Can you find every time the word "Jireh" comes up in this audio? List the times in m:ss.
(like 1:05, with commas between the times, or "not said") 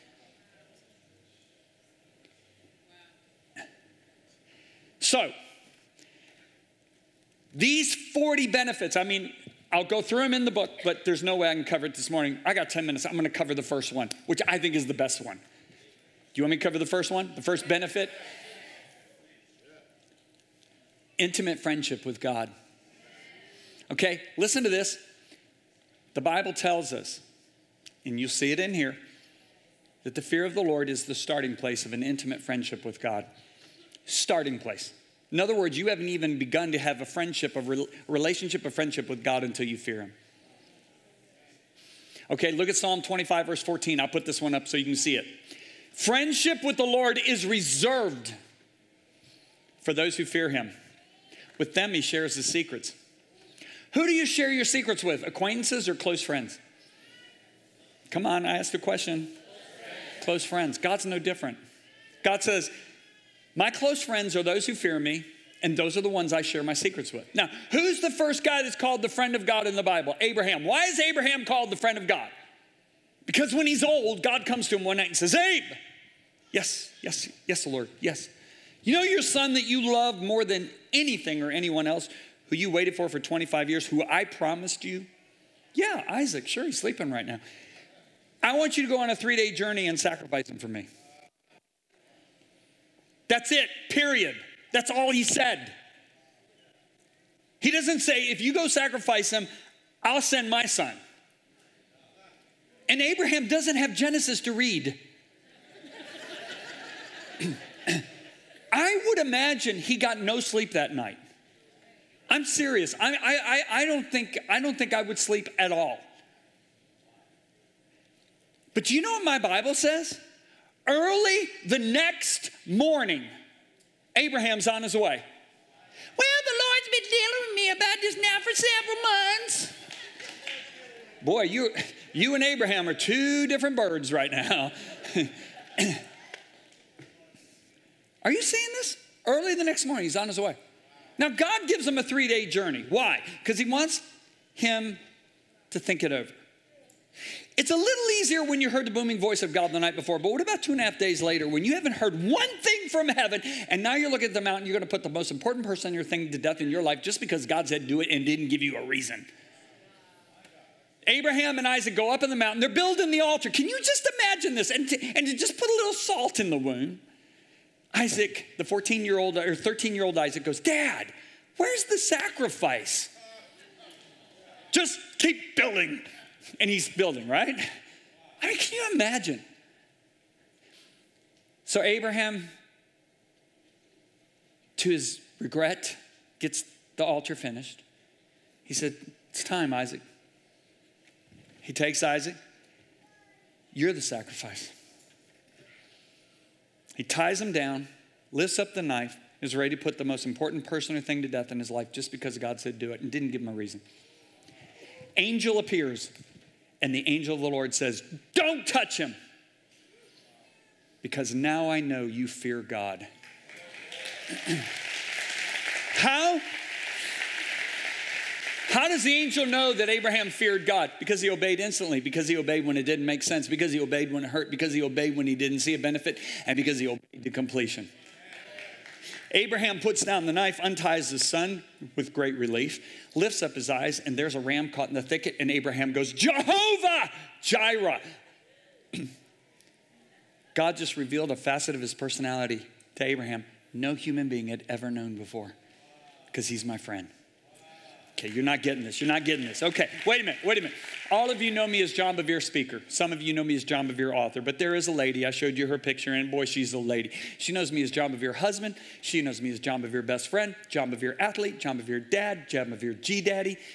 3:57.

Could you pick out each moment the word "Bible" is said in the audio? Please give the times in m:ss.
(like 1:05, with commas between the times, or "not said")
0:26, 1:09, 1:59.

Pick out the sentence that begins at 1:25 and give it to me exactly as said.
Yeah, Isaac, sure, he's sleeping right now.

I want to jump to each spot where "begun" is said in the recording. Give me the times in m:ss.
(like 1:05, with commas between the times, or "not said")
0:36.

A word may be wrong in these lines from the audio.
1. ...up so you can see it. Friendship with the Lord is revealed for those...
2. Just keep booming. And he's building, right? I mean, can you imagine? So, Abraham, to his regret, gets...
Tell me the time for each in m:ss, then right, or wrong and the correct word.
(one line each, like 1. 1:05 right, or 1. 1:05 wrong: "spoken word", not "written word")
1. 0:44 wrong: "reserved", not "revealed"
2. 2:54 wrong: "building", not "booming".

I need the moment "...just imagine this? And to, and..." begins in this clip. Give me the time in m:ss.
2:43.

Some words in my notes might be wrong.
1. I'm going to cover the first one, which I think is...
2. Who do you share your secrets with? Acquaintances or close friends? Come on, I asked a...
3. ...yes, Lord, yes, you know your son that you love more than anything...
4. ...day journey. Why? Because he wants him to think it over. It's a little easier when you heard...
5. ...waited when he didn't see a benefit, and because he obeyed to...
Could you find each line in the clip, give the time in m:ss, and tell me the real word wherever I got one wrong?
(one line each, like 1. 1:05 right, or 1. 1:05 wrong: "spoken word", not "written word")
1. 0:13 right
2. 0:53 right
3. 1:17 right
4. 2:22 right
5. 3:44 wrong: "obeyed", not "waited".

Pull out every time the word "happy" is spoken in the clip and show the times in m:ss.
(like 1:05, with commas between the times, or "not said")
not said.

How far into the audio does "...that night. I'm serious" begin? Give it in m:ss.
1:50.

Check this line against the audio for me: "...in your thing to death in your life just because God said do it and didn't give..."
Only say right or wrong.
right.